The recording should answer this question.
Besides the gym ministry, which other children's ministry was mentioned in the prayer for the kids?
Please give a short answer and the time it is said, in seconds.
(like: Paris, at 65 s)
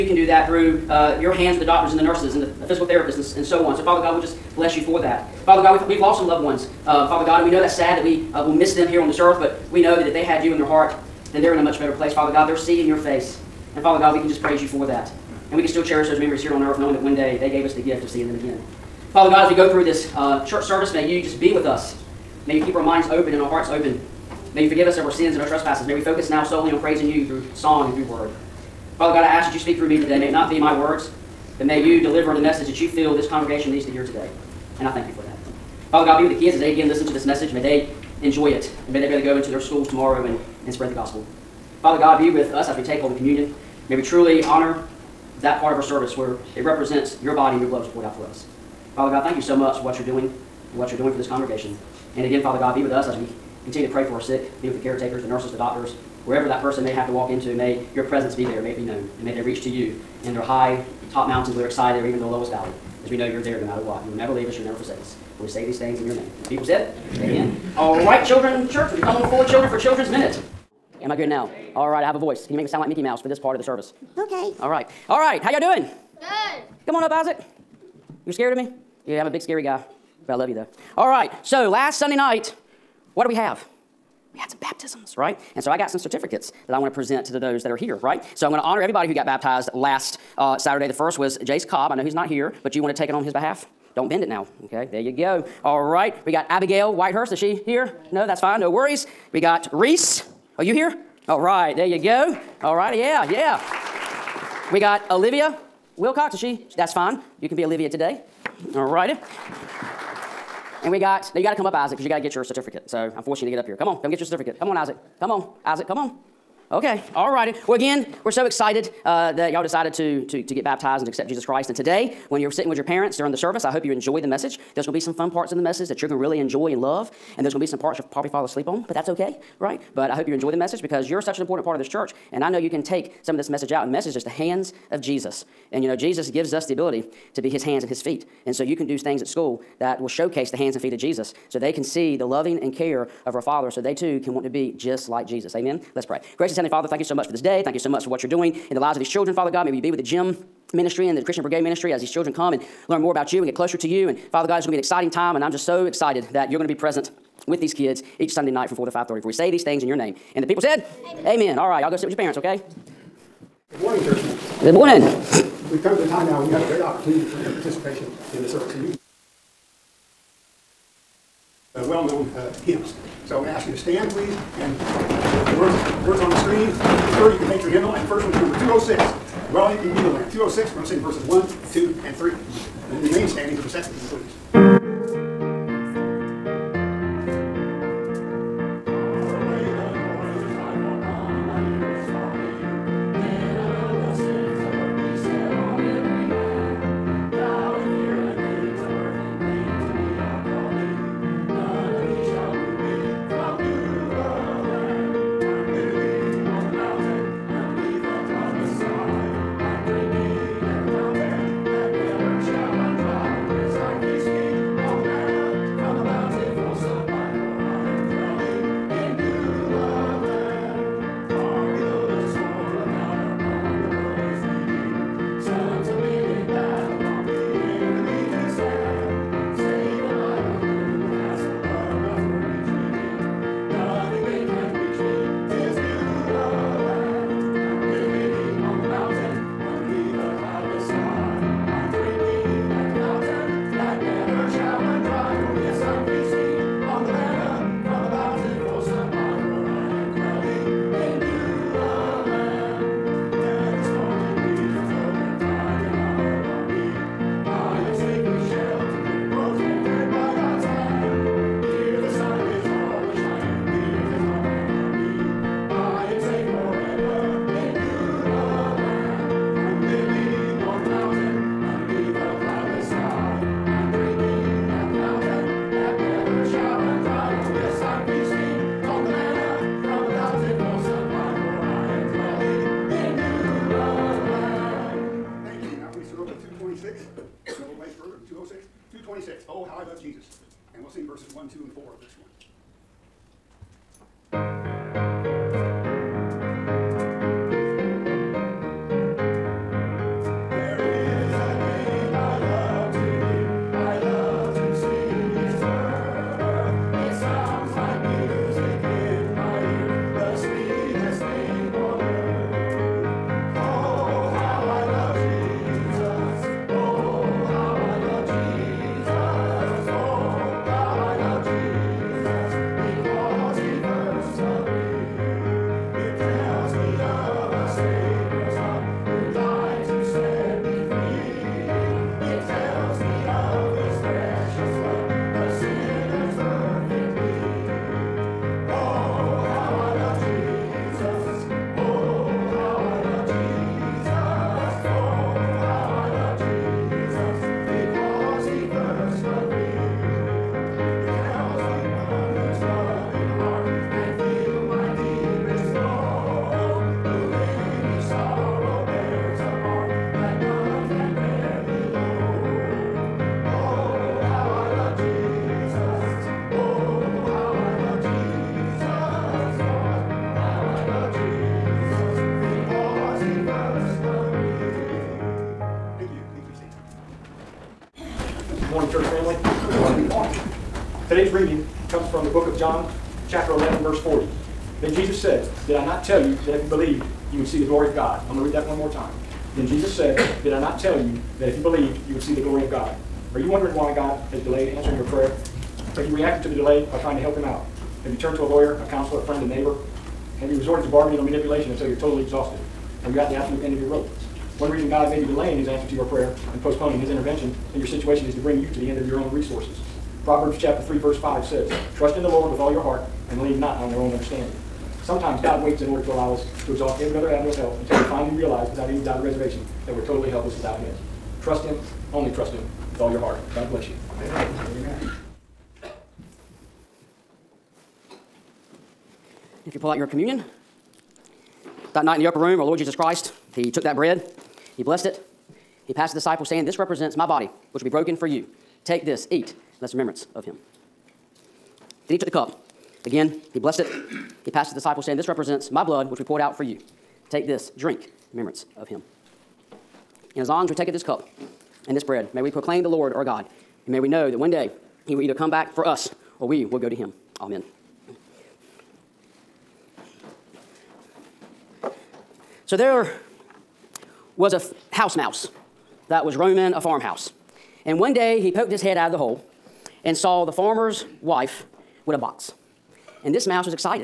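Christian Brigade, at 151 s.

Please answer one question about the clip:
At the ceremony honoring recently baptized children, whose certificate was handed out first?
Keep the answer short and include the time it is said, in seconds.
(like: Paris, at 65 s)
Jace Cobb, at 91 s.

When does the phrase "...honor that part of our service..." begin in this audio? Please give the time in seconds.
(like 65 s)
44 s.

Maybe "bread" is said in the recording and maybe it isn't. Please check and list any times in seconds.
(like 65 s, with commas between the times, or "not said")
433 s, 452 s.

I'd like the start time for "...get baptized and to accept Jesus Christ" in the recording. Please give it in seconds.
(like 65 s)
120 s.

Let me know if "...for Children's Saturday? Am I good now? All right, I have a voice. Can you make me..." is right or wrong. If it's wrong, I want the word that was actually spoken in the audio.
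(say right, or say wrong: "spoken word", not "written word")
wrong: "Minute", not "Saturday".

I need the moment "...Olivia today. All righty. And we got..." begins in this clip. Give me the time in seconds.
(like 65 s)
107 s.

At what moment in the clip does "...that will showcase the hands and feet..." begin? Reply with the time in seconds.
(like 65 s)
139 s.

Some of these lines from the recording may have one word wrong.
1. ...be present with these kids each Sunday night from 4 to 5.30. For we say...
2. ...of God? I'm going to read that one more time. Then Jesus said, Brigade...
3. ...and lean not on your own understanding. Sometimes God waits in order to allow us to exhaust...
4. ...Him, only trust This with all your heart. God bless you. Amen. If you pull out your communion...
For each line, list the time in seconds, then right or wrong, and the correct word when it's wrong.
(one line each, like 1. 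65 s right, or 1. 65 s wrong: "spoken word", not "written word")
1. 156 s right
2. 387 s wrong: "Did", not "Brigade"
3. 413 s right
4. 421 s wrong: "Him", not "This".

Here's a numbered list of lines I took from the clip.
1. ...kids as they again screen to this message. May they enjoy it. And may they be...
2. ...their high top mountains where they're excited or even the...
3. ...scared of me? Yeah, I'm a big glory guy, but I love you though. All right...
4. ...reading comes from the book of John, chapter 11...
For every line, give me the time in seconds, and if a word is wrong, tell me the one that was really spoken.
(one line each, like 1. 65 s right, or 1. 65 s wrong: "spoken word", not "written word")
1. 36 s wrong: "listen", not "screen"
2. 60 s right
3. 78 s wrong: "scary", not "glory"
4. 381 s right.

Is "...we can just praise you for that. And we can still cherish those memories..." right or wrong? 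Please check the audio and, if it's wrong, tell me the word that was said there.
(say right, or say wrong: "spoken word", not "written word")
right.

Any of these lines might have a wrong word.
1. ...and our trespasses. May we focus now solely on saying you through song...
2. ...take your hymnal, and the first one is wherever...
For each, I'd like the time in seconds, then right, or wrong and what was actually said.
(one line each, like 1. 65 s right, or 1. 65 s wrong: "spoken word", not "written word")
1. 25 s wrong: "praising", not "saying"
2. 177 s wrong: "number", not "wherever".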